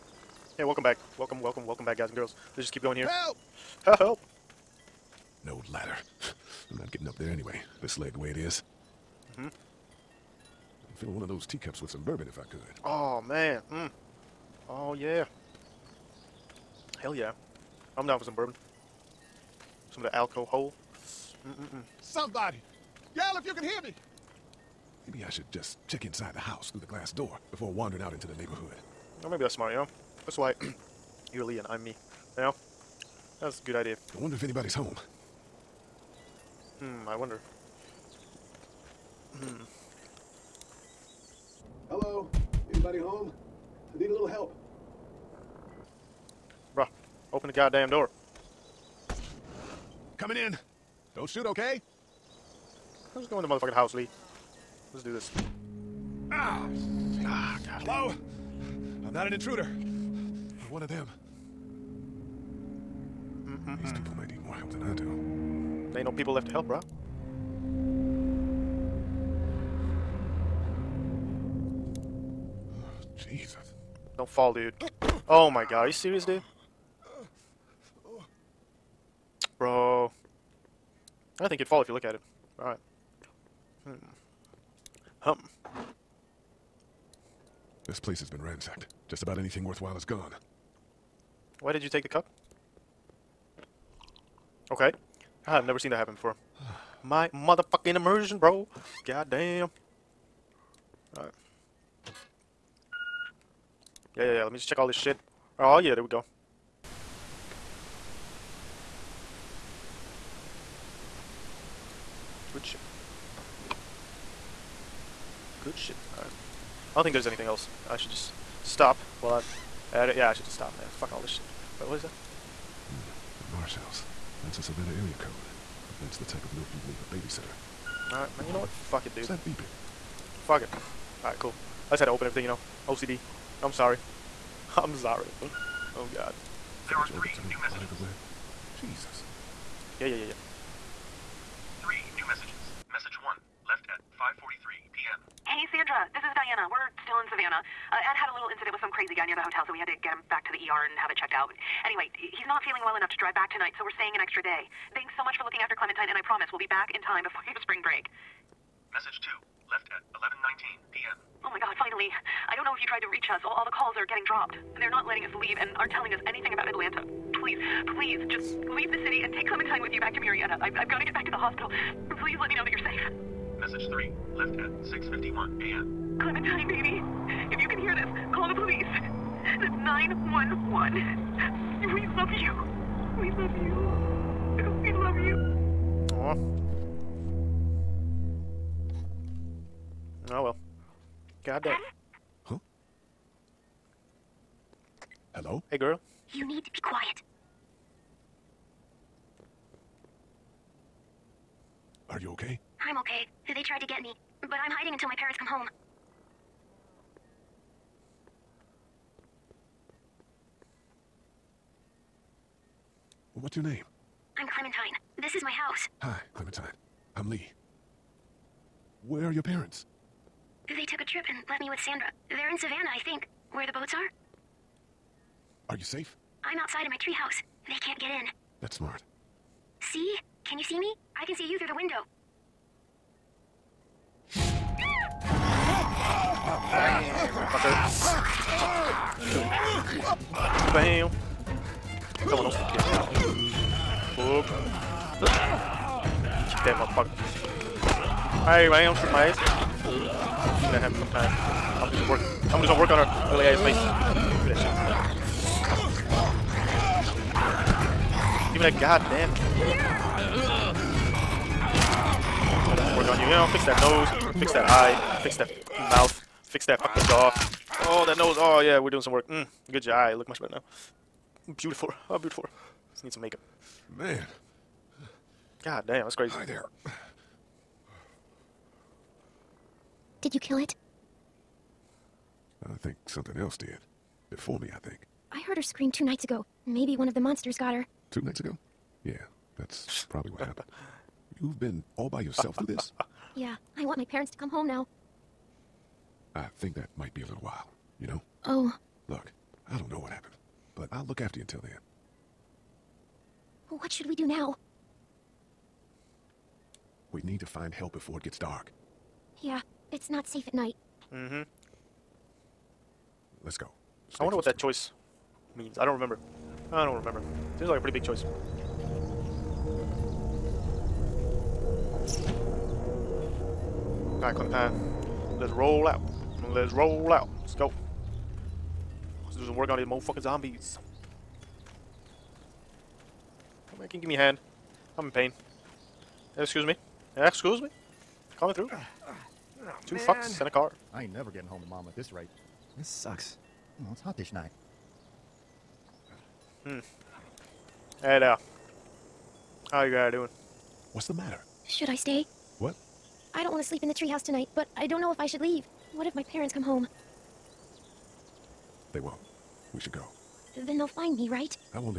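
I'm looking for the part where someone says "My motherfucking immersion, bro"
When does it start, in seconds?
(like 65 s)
97 s.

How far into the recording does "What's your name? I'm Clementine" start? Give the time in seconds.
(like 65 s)
213 s.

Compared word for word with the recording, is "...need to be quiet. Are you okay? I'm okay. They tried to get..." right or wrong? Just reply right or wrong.
right.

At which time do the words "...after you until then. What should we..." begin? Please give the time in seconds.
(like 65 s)
301 s.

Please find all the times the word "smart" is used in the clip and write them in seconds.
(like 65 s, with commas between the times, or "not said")
29 s, 228 s.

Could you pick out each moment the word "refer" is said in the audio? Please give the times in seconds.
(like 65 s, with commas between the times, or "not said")
not said.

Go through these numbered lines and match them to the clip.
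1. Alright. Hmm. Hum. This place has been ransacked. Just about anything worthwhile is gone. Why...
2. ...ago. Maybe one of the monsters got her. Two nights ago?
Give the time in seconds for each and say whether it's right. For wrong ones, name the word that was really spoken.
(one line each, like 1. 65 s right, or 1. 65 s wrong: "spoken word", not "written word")
1. 82 s right
2. 286 s right.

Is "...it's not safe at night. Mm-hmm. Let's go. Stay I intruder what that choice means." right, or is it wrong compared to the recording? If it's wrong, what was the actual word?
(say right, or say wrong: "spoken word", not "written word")
wrong: "wonder", not "intruder".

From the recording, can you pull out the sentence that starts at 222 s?
They're in Savannah, I think, where the boats are.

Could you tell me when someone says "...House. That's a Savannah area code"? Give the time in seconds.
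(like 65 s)
123 s.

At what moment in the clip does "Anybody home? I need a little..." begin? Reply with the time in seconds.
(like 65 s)
42 s.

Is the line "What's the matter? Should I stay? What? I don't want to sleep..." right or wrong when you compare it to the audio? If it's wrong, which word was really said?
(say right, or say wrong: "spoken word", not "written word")
right.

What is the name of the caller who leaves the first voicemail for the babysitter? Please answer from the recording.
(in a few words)
Diana.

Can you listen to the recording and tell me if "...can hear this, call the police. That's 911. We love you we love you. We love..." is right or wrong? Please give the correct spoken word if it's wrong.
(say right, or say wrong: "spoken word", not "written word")
right.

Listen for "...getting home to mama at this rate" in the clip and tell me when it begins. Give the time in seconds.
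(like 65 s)
341 s.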